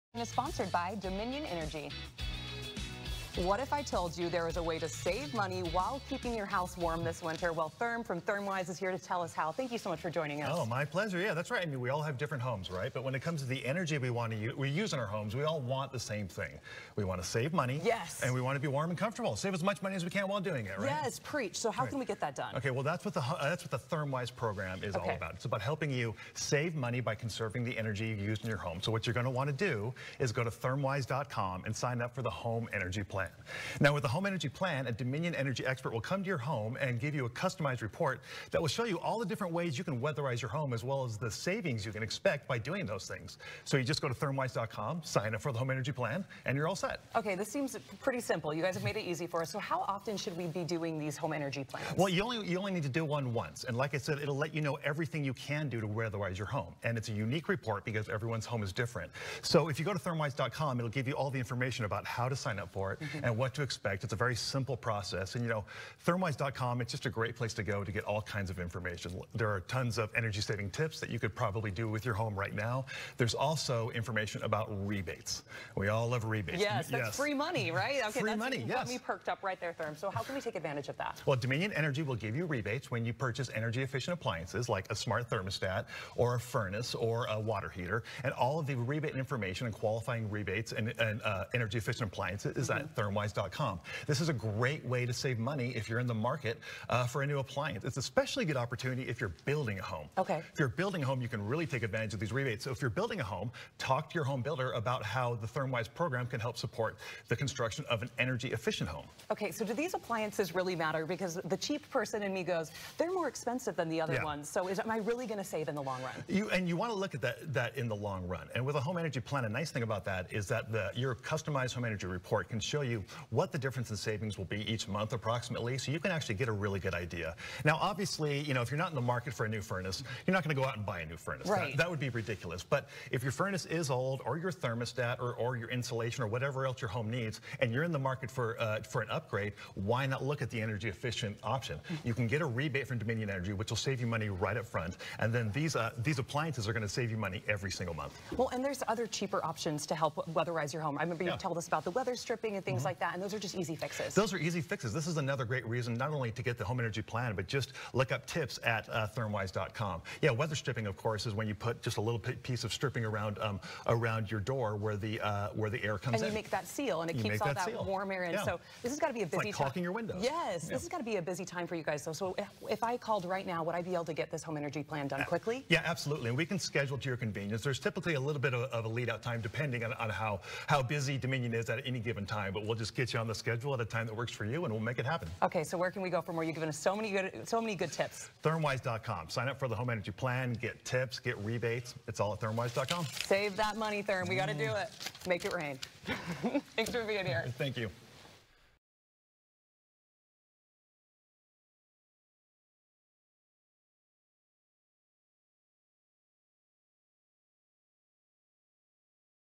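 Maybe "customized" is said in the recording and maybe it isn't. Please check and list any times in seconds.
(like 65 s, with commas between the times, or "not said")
37 s, 121 s.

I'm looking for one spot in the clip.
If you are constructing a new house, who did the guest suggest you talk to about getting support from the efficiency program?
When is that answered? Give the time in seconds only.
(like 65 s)
104 s.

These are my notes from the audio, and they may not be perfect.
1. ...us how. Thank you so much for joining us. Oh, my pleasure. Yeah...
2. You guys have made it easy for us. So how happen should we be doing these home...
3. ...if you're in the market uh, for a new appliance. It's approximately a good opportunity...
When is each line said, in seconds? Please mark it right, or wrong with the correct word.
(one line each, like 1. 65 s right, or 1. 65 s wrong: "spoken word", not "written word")
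1. 9 s right
2. 48 s wrong: "often", not "happen"
3. 95 s wrong: "especially", not "approximately".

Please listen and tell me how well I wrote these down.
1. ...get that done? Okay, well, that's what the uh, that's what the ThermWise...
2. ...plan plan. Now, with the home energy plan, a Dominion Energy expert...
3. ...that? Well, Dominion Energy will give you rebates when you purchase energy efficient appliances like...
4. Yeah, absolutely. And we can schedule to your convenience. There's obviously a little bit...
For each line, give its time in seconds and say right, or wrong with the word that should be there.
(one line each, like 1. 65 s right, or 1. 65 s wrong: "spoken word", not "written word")
1. 22 s right
2. 33 s right
3. 80 s right
4. 175 s wrong: "typically", not "obviously".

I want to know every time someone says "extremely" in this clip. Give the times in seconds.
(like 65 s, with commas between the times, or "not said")
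not said.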